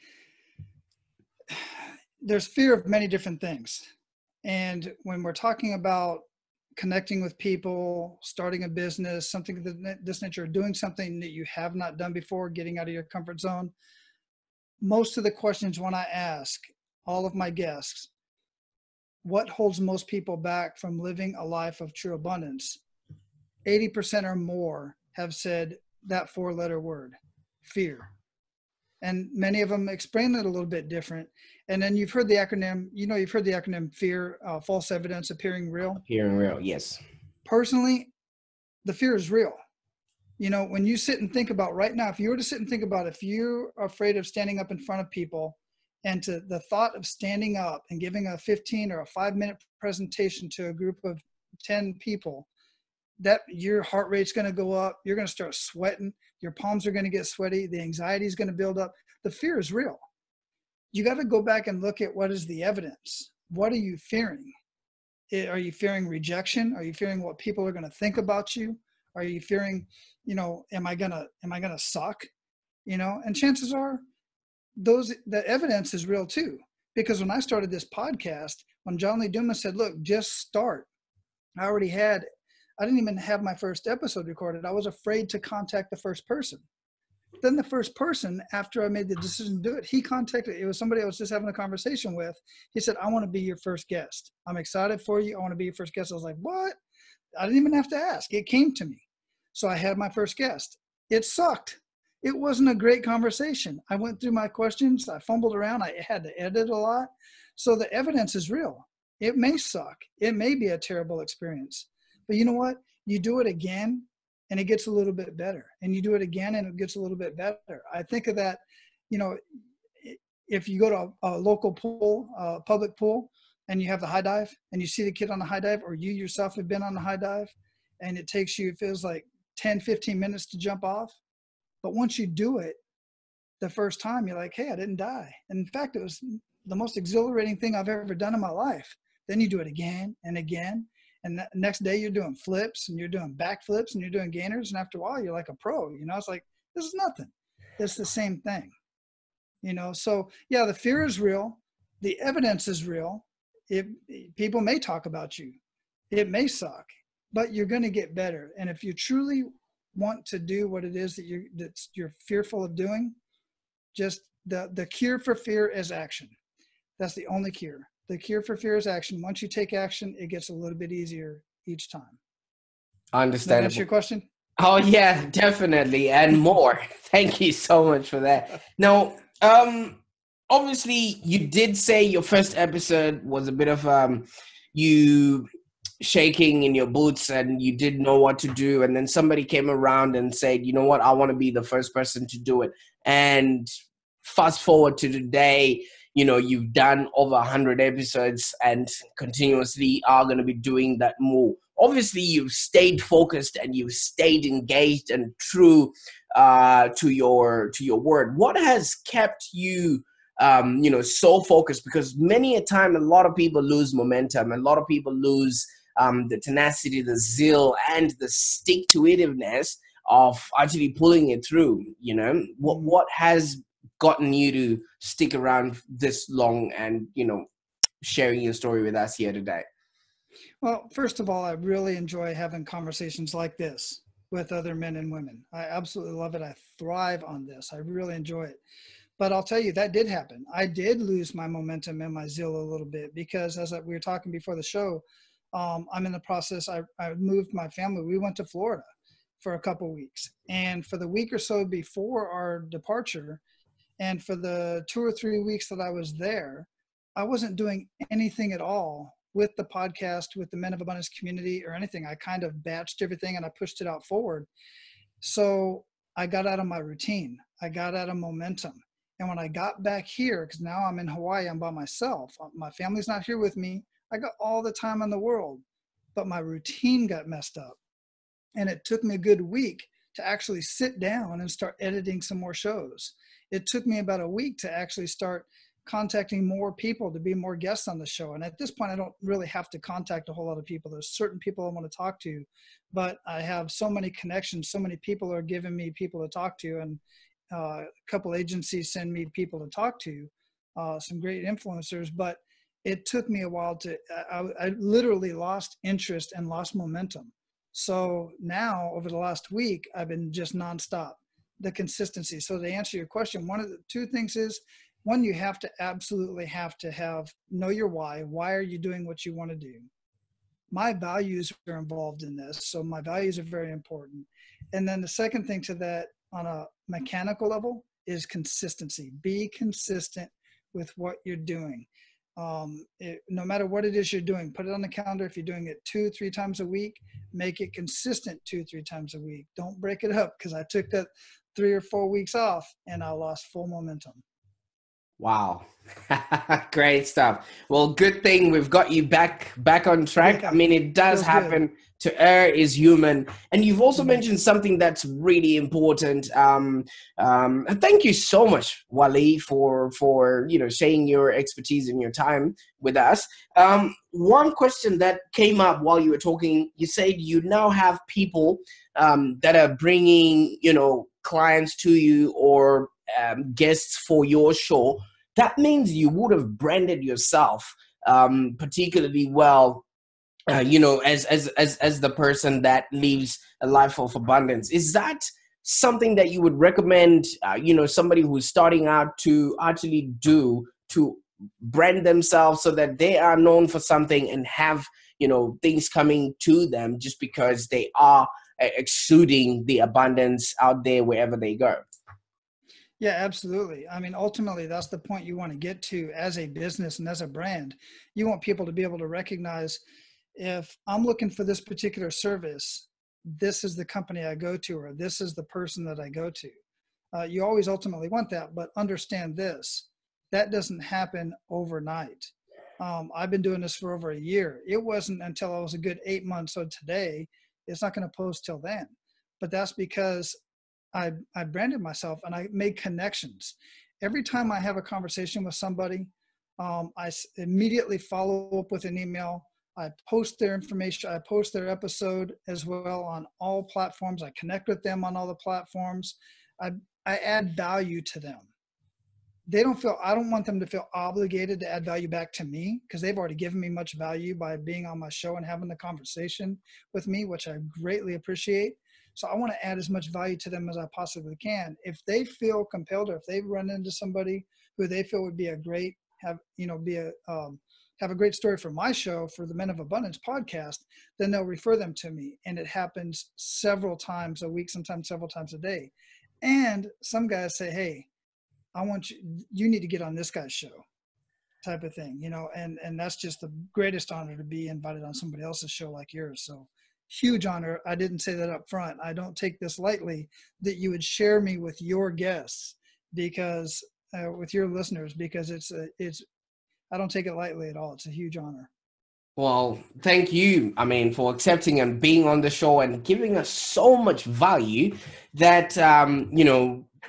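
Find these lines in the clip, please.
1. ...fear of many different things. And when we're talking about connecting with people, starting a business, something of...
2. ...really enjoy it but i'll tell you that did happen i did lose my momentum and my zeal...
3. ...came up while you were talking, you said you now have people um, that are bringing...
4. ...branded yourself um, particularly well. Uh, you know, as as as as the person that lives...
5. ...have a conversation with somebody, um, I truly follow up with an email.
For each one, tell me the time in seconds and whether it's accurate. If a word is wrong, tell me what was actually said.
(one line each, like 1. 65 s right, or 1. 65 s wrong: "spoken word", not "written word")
1. 2 s right
2. 237 s right
3. 365 s right
4. 376 s right
5. 434 s wrong: "immediately", not "truly".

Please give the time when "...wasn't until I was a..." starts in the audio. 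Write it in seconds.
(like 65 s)
424 s.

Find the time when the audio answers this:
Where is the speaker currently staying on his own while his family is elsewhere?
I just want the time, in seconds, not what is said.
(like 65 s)
271 s.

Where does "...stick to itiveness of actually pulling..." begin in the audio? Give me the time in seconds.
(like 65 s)
218 s.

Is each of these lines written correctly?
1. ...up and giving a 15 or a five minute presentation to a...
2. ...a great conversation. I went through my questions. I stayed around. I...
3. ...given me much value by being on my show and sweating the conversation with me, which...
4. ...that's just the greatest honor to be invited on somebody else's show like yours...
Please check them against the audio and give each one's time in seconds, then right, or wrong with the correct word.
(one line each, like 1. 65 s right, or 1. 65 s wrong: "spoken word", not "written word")
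1. 47 s right
2. 102 s wrong: "fumbled", not "stayed"
3. 453 s wrong: "having", not "sweating"
4. 482 s right.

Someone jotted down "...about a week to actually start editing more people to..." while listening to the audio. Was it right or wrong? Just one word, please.
wrong.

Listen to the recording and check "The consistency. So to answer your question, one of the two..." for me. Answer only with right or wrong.
right.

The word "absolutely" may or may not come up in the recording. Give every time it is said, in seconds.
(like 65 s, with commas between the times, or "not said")
235 s, 315 s, 403 s.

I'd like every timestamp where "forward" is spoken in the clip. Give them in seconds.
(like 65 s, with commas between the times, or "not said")
194 s, 264 s.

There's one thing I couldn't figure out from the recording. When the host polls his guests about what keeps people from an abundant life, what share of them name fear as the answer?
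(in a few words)
80%.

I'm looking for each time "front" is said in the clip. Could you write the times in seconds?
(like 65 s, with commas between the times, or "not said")
44 s, 488 s.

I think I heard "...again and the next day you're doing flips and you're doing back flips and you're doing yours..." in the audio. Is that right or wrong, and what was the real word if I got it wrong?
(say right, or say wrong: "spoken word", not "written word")
wrong: "gainers", not "yours".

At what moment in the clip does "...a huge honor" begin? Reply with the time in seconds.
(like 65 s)
498 s.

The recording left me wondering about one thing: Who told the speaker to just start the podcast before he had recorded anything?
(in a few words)
John Lee Dumas.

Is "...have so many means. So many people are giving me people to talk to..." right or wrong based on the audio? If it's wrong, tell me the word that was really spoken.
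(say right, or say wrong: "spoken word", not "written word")
wrong: "connections", not "means".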